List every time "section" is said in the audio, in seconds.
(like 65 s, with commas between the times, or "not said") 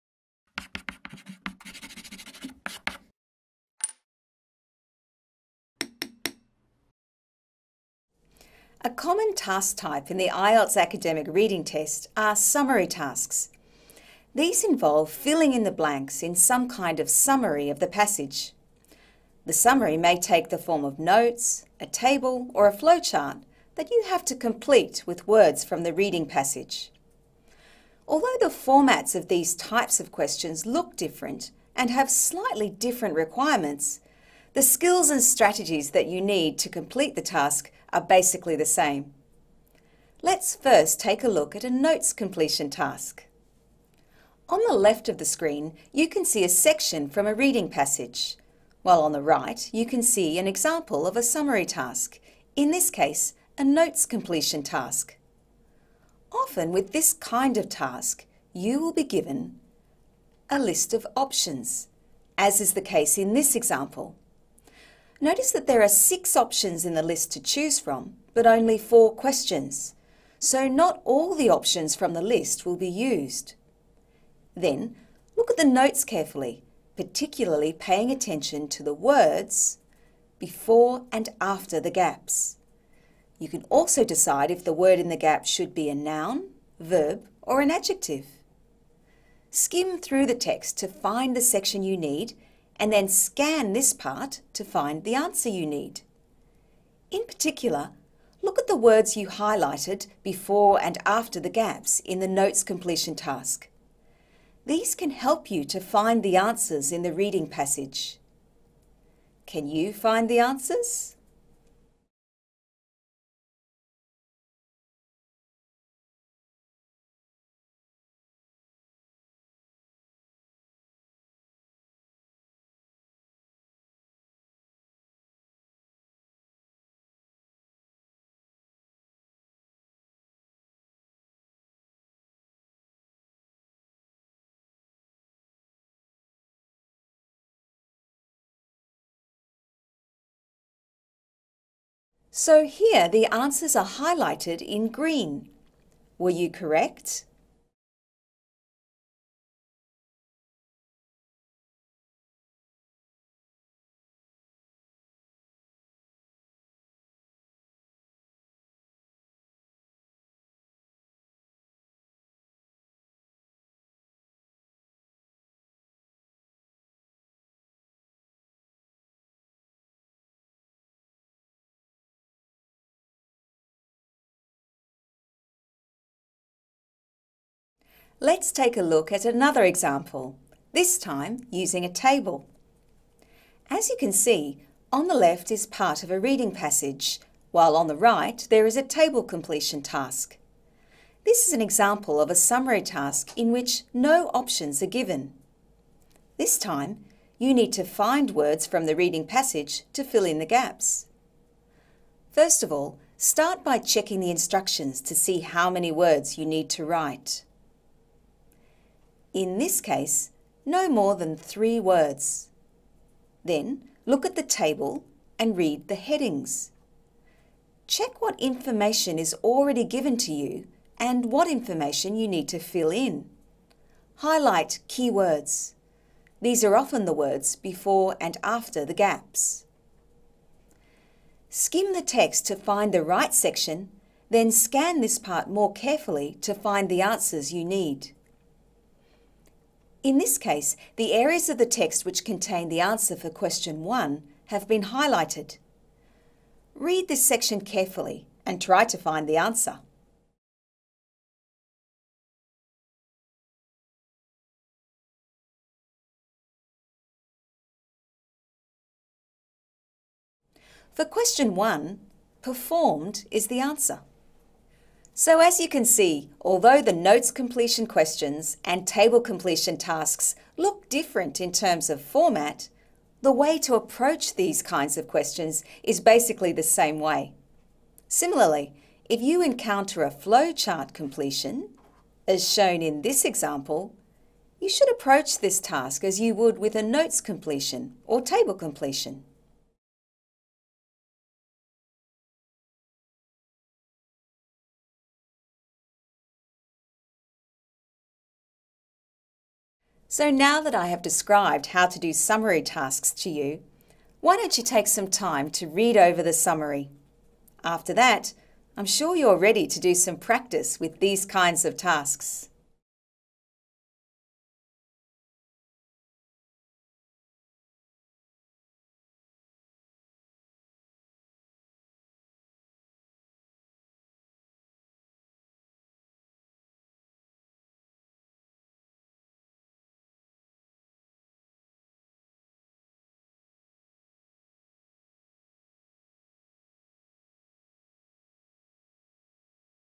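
46 s, 91 s, 233 s, 247 s.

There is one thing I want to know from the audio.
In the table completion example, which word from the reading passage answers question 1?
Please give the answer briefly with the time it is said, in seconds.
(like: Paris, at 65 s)
performed, at 262 s.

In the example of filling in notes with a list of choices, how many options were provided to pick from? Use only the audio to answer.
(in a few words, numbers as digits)
6.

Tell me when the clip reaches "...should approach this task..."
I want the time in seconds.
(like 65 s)
284 s.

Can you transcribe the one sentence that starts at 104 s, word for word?
These can help you to find the answers in the reading passage.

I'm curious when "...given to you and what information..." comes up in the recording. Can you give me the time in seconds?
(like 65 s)
219 s.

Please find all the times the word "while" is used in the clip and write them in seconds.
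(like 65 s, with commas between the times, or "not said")
48 s, 187 s.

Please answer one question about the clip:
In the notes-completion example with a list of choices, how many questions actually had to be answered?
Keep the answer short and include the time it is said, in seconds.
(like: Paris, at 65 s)
4, at 68 s.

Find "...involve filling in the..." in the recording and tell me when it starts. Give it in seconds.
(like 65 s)
14 s.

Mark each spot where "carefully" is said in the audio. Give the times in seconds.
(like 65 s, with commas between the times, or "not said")
76 s, 235 s, 247 s.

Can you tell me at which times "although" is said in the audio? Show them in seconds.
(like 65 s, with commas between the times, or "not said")
28 s, 266 s.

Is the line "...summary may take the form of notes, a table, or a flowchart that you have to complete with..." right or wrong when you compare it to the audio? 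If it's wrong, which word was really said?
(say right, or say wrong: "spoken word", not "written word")
right.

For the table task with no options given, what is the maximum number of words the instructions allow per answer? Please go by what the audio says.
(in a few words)
3.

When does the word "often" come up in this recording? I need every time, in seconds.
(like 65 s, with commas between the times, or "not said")
56 s, 226 s.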